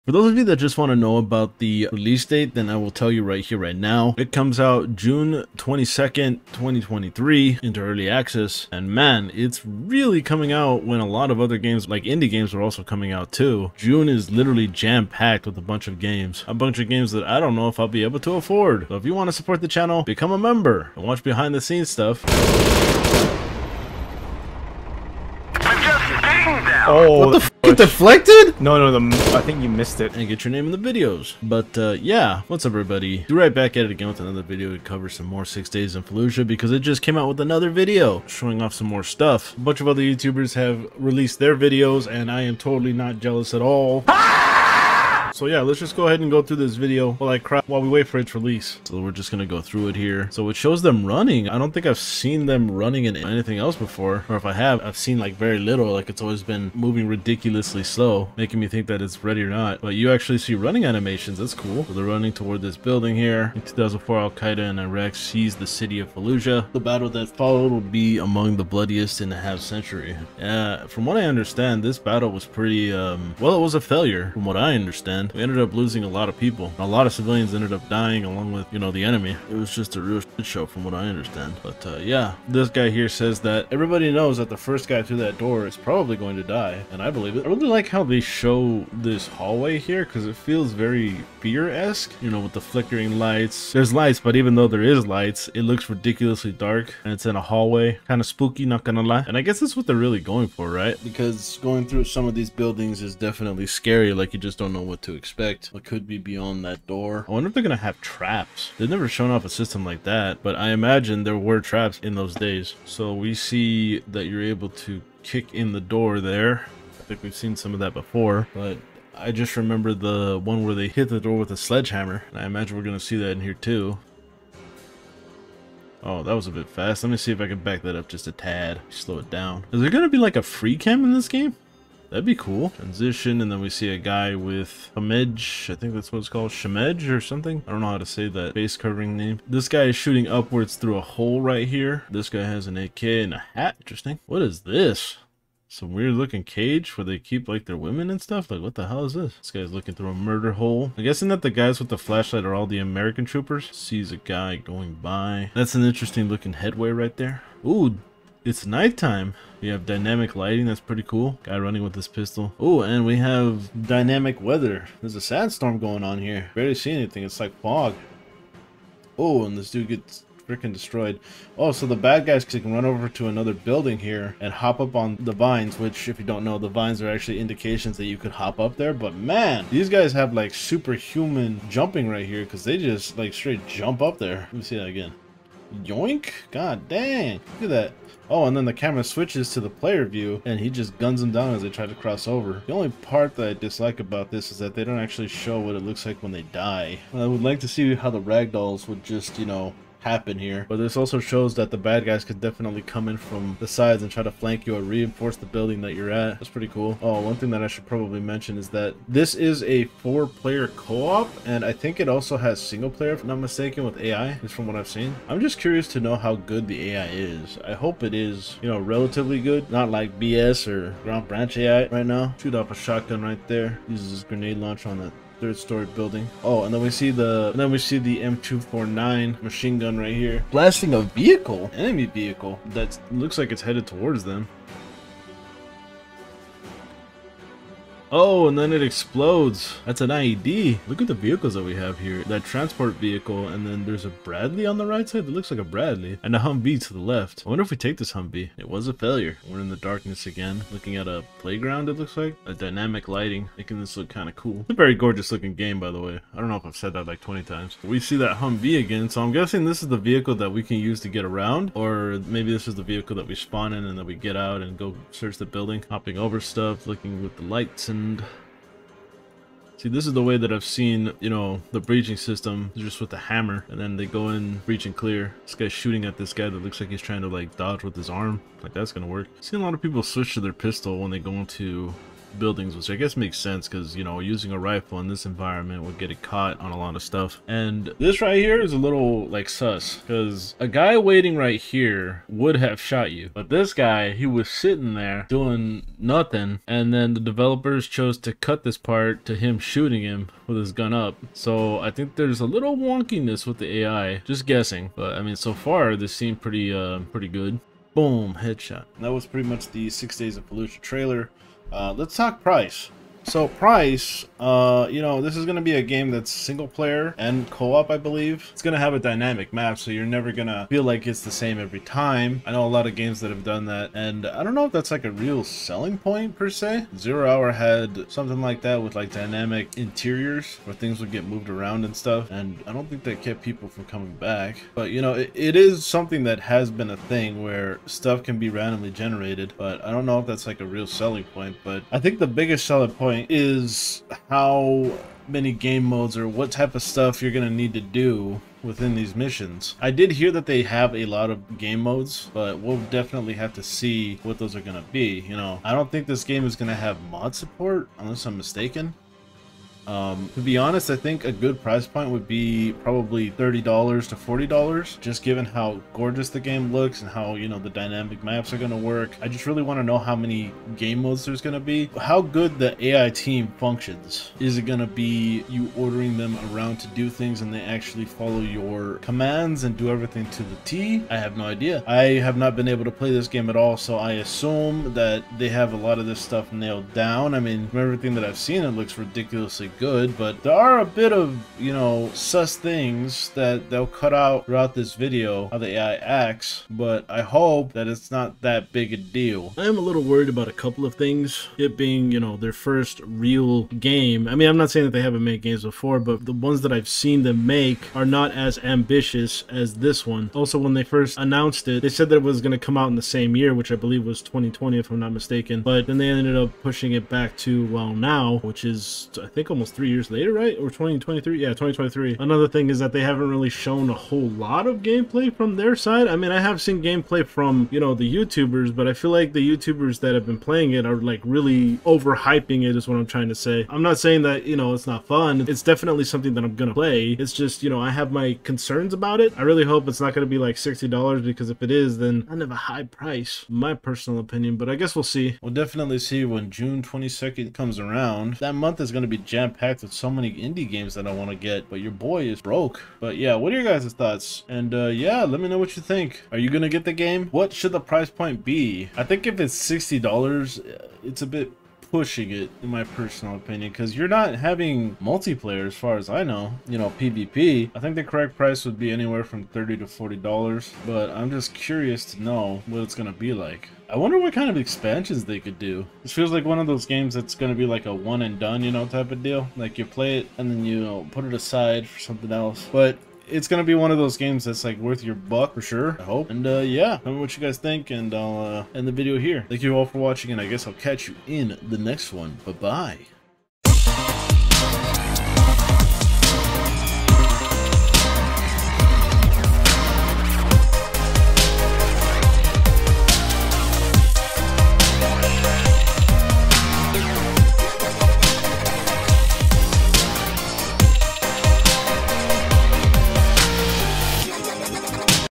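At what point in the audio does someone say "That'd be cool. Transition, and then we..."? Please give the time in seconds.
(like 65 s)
132 s.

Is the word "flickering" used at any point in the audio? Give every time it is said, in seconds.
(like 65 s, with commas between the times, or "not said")
92 s.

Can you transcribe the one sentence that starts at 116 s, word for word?
I think we've seen some of that before, but I just remember the one where they hit the door with a sledgehammer.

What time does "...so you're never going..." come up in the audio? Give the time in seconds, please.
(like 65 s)
319 s.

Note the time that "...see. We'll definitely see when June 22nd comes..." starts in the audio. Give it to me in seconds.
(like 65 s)
445 s.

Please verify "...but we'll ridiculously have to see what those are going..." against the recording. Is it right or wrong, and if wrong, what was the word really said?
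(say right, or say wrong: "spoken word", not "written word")
wrong: "definitely", not "ridiculously".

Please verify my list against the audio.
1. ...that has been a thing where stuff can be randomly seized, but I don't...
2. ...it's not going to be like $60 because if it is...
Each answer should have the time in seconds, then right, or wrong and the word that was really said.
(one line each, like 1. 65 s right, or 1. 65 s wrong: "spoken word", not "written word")
1. 336 s wrong: "generated", not "seized"
2. 439 s right.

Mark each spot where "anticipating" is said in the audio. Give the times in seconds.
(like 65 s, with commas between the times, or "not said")
not said.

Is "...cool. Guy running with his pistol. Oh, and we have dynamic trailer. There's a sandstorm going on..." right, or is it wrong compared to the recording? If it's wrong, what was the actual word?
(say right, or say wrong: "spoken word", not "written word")
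wrong: "weather", not "trailer".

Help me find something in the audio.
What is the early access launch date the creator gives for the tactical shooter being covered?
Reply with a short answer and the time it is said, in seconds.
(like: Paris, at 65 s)
June 22nd, 2023, at 4 s.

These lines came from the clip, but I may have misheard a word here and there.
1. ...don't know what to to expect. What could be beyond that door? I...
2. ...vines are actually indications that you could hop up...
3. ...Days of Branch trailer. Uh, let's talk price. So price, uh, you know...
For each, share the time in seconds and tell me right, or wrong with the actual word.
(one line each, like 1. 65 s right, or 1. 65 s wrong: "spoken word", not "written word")
1. 104 s right
2. 176 s right
3. 310 s wrong: "Fallujah", not "Branch".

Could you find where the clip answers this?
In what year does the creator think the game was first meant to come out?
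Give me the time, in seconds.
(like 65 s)
414 s.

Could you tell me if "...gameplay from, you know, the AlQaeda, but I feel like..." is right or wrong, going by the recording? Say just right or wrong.
wrong.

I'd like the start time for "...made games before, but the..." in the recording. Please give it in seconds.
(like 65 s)
405 s.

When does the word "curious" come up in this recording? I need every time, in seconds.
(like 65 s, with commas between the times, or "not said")
215 s, 471 s.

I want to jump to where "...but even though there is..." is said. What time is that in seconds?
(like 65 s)
94 s.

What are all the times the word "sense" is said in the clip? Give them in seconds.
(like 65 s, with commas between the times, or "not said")
283 s.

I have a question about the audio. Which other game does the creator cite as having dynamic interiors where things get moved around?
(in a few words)
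Zero Hour.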